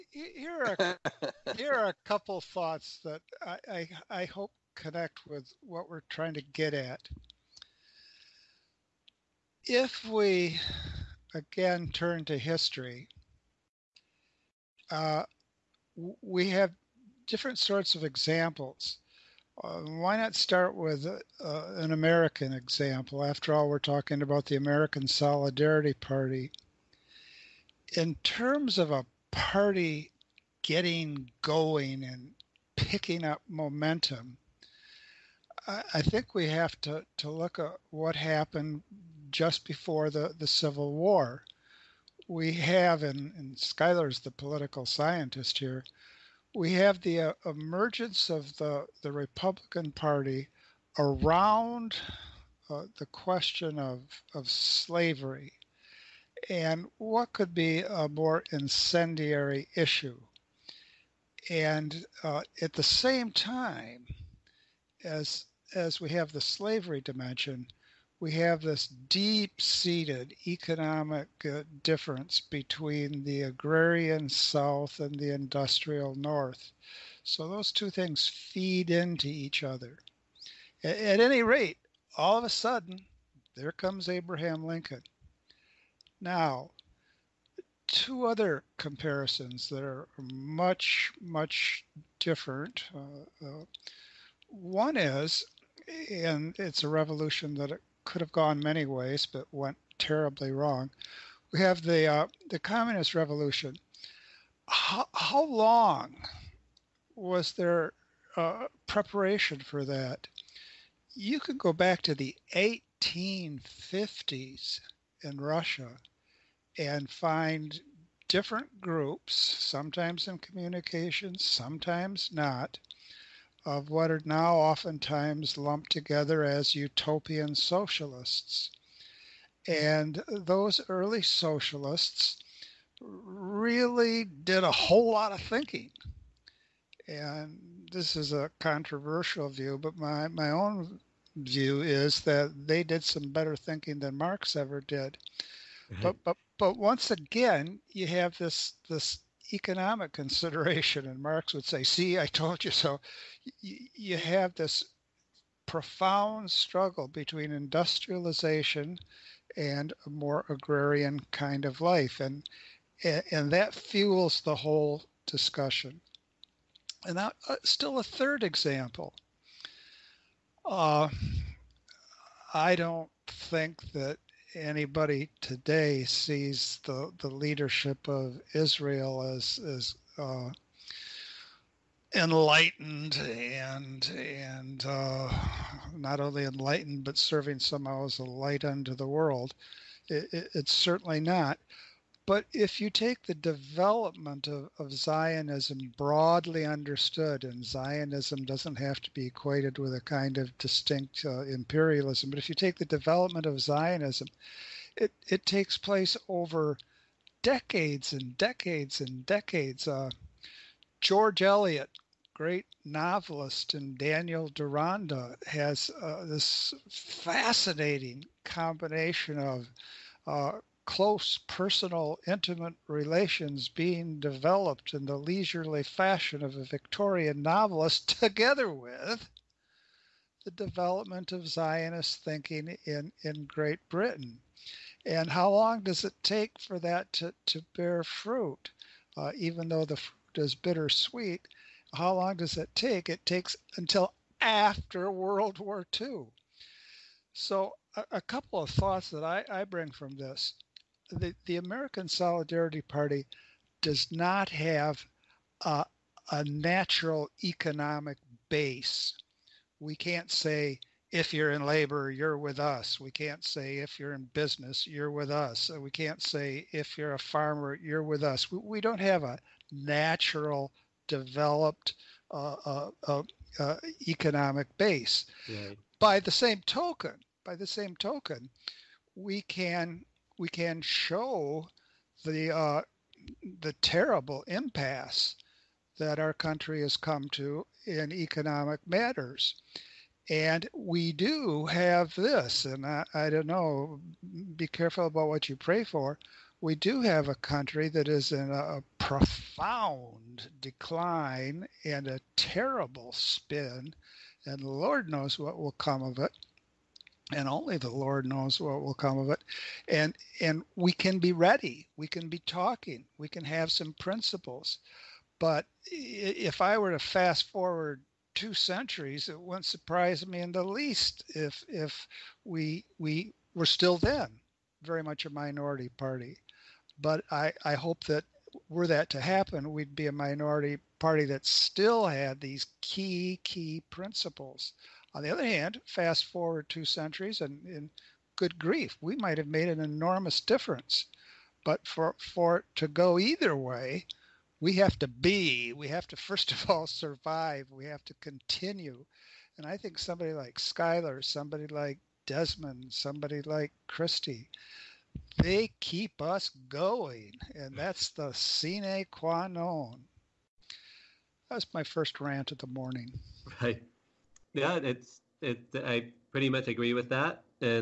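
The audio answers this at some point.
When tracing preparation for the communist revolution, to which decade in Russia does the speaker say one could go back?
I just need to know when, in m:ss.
1:52.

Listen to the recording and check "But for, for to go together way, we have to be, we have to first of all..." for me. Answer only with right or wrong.
wrong.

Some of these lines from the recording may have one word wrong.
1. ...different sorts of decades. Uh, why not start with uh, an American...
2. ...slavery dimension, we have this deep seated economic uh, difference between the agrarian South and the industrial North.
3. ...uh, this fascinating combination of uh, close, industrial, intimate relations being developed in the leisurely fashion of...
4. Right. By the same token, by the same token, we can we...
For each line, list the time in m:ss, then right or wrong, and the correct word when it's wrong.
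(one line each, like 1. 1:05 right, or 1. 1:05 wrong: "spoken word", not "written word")
1. 0:17 wrong: "examples", not "decades"
2. 1:06 right
3. 3:35 wrong: "personal", not "industrial"
4. 4:35 right.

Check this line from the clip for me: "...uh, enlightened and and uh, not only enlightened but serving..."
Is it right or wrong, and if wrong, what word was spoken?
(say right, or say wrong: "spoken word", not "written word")
right.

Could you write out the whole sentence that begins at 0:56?
And what could be a more incendiary issue?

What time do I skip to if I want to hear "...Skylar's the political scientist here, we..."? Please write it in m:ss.
0:43.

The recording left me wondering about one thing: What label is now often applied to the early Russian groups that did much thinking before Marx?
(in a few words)
utopian socialists.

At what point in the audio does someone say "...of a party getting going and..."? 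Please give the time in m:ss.
0:28.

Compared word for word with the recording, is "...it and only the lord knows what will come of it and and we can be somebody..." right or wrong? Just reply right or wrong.
wrong.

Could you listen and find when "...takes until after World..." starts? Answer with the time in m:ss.
4:03.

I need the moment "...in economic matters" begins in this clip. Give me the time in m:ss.
4:47.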